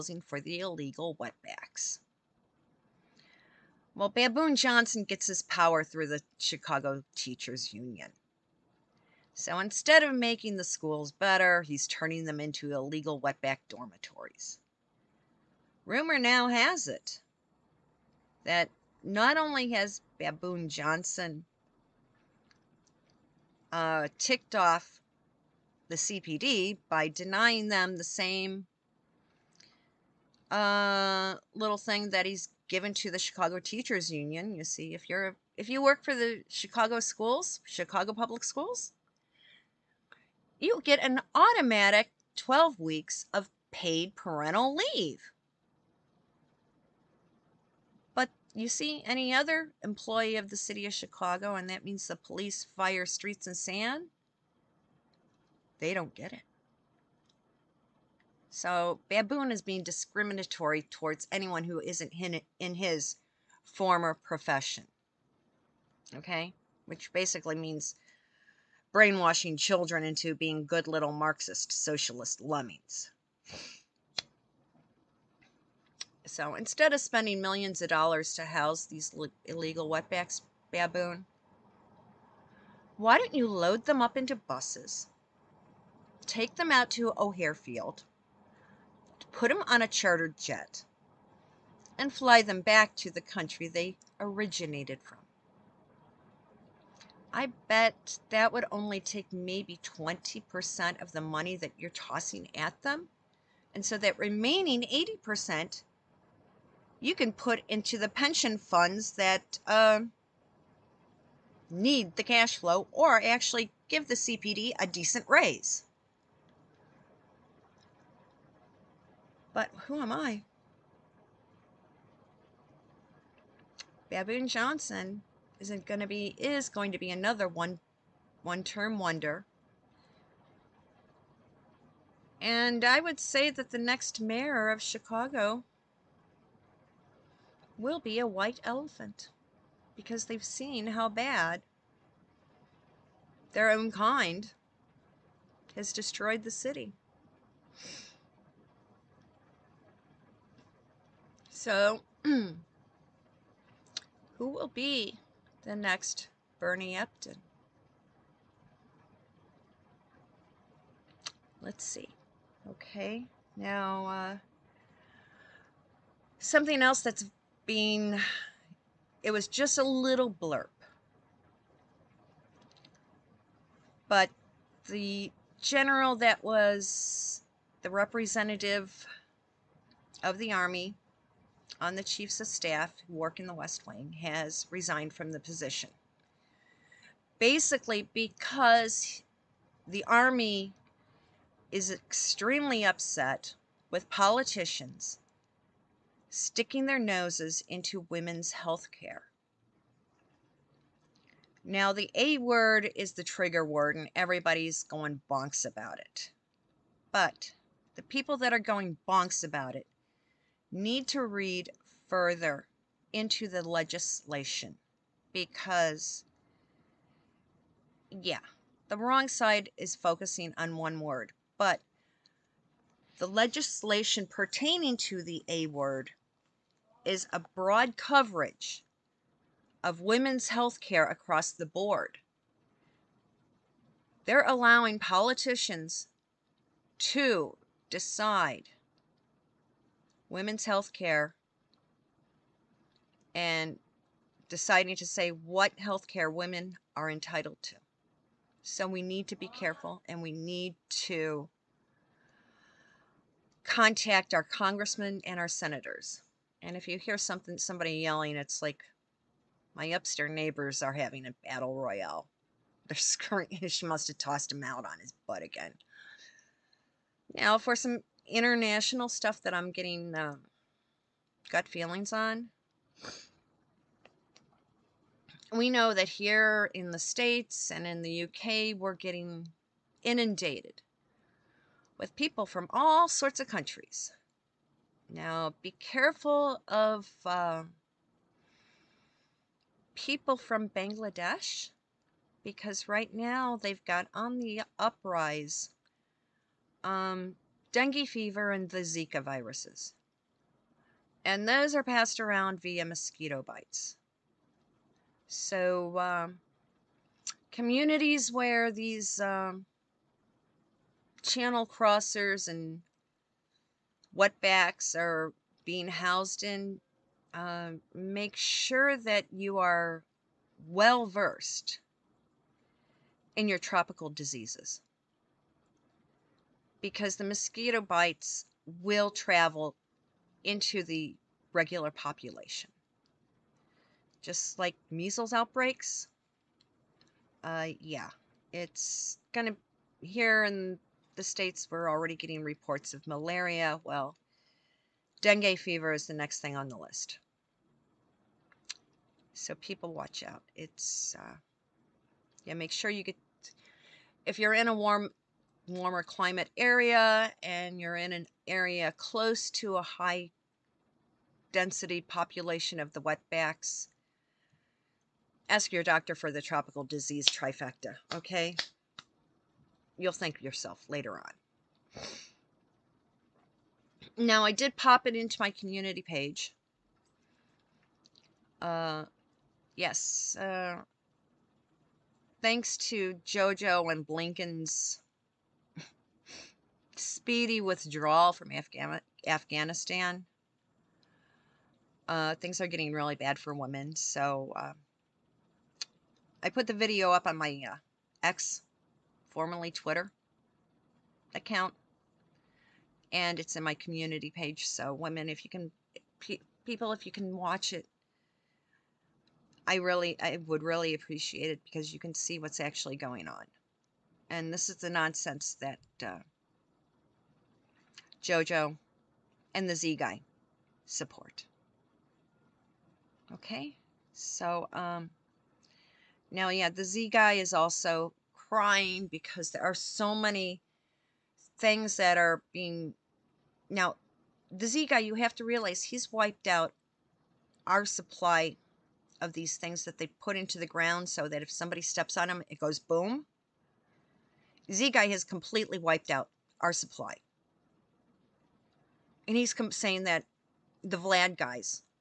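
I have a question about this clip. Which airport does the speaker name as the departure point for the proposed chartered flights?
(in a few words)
O'Hare Field.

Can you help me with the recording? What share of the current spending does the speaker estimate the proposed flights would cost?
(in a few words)
20%.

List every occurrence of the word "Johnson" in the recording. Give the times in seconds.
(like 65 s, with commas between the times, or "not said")
4 s, 20 s, 124 s.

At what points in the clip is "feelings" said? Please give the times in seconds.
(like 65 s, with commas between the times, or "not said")
271 s.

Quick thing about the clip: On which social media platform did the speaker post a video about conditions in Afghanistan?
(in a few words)
X.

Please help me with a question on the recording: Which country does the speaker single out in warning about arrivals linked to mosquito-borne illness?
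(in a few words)
Bangladesh.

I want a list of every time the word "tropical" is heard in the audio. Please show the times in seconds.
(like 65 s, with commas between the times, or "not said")
323 s, 366 s.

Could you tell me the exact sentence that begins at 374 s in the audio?
Now, I did pop it into my community page.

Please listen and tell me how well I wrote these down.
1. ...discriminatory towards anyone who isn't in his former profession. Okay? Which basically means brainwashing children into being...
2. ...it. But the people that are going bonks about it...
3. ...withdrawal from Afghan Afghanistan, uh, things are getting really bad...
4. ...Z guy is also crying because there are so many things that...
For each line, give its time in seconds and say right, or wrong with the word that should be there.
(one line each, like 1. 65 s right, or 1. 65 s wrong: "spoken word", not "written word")
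1. 59 s right
2. 205 s right
3. 387 s right
4. 426 s right.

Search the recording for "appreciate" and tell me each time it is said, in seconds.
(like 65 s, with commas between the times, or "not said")
410 s.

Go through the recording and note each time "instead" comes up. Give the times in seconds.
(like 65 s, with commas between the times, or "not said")
9 s, 76 s.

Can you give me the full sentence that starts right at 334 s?
Just like measles outbreaks, uh, yeah, it's gonna here in the states were already getting reports of malaria.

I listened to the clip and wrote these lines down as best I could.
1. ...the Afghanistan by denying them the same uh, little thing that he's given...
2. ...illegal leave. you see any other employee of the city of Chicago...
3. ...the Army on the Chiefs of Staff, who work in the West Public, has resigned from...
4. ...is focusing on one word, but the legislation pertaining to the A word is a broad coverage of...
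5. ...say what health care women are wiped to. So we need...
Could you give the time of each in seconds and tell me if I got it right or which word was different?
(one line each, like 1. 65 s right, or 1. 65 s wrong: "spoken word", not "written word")
1. 25 s wrong: "CPD", not "Afghanistan"
2. 44 s wrong: "parental", not "illegal"
3. 180 s wrong: "Wing", not "Public"
4. 219 s right
5. 245 s wrong: "entitled", not "wiped".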